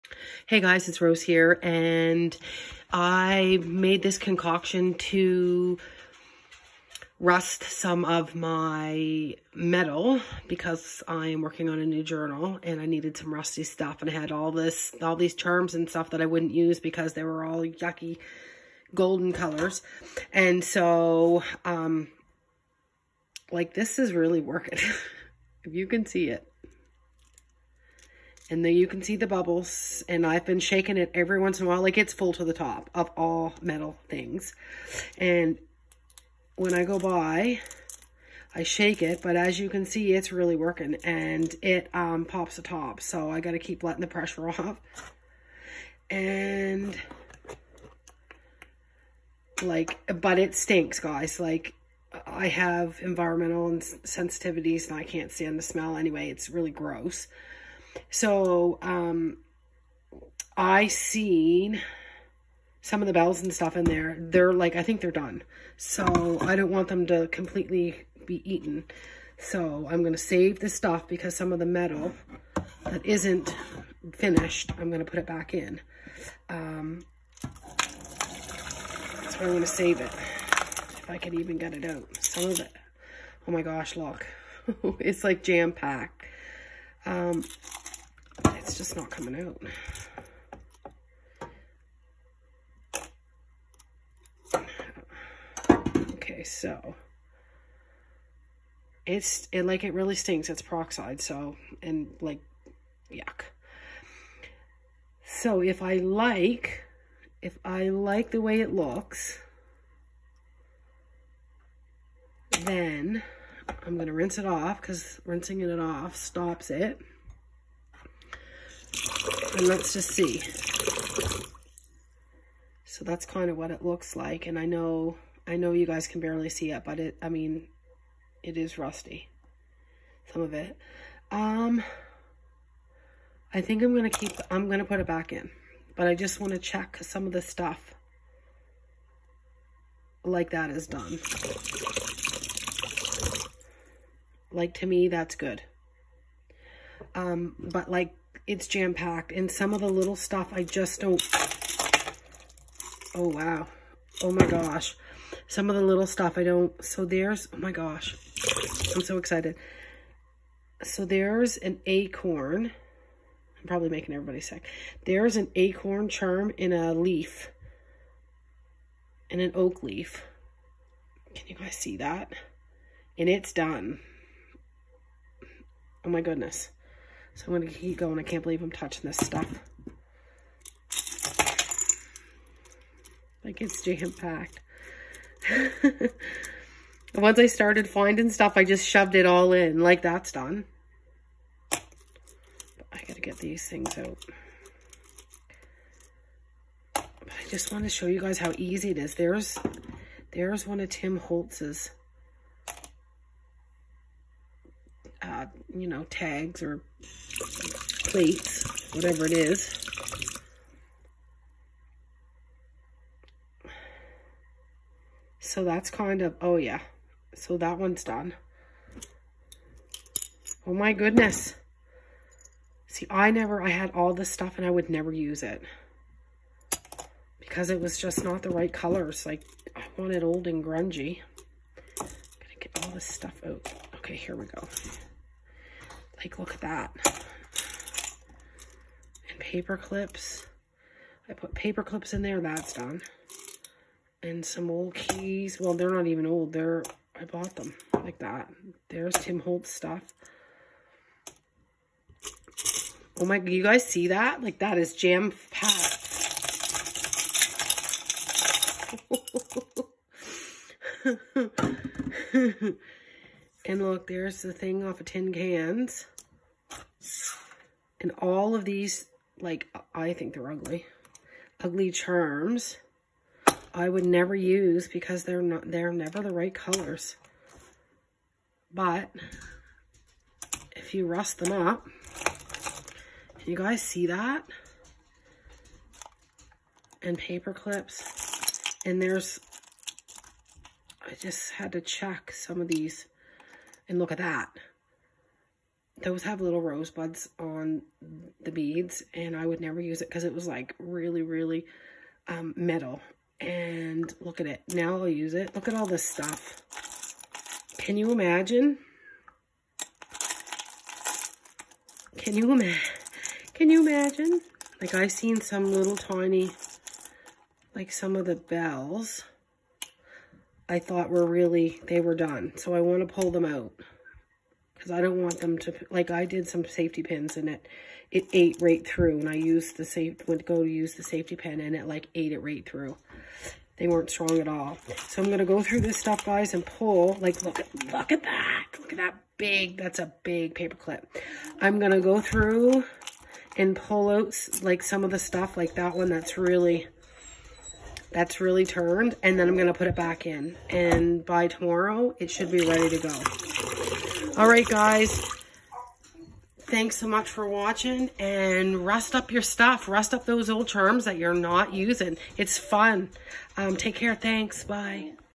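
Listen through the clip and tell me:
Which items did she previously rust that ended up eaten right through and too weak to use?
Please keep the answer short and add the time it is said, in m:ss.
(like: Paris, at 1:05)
Safety pins, at 5:26.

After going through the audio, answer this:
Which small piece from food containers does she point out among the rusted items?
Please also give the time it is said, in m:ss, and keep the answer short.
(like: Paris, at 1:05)
The thing off of tin cans, at 4:25.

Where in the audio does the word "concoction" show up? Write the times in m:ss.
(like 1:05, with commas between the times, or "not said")
0:04.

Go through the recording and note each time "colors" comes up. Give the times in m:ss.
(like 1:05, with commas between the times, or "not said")
0:19, 3:48, 4:36.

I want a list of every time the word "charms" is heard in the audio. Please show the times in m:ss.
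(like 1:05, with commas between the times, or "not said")
0:15, 2:46, 4:31, 6:00.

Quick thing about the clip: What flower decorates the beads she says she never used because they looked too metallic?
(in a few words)
Rosebuds.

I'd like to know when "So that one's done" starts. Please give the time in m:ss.
3:37.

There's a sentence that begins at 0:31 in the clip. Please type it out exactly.
Like it's full to the top of all metal things.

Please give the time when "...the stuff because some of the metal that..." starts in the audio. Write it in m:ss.
1:10.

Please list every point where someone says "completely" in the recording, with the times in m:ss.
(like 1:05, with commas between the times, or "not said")
1:07.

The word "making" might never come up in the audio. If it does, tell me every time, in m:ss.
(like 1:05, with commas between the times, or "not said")
2:43.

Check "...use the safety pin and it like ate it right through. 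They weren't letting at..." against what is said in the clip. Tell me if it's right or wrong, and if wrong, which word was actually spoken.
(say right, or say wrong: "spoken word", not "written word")
wrong: "strong", not "letting".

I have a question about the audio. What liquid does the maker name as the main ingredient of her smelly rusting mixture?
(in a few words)
Peroxide.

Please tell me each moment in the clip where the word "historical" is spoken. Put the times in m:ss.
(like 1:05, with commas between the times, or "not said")
not said.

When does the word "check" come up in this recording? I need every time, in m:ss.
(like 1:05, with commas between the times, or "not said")
2:16, 4:51.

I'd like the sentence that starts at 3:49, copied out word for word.
Like, I wanted old and grungy.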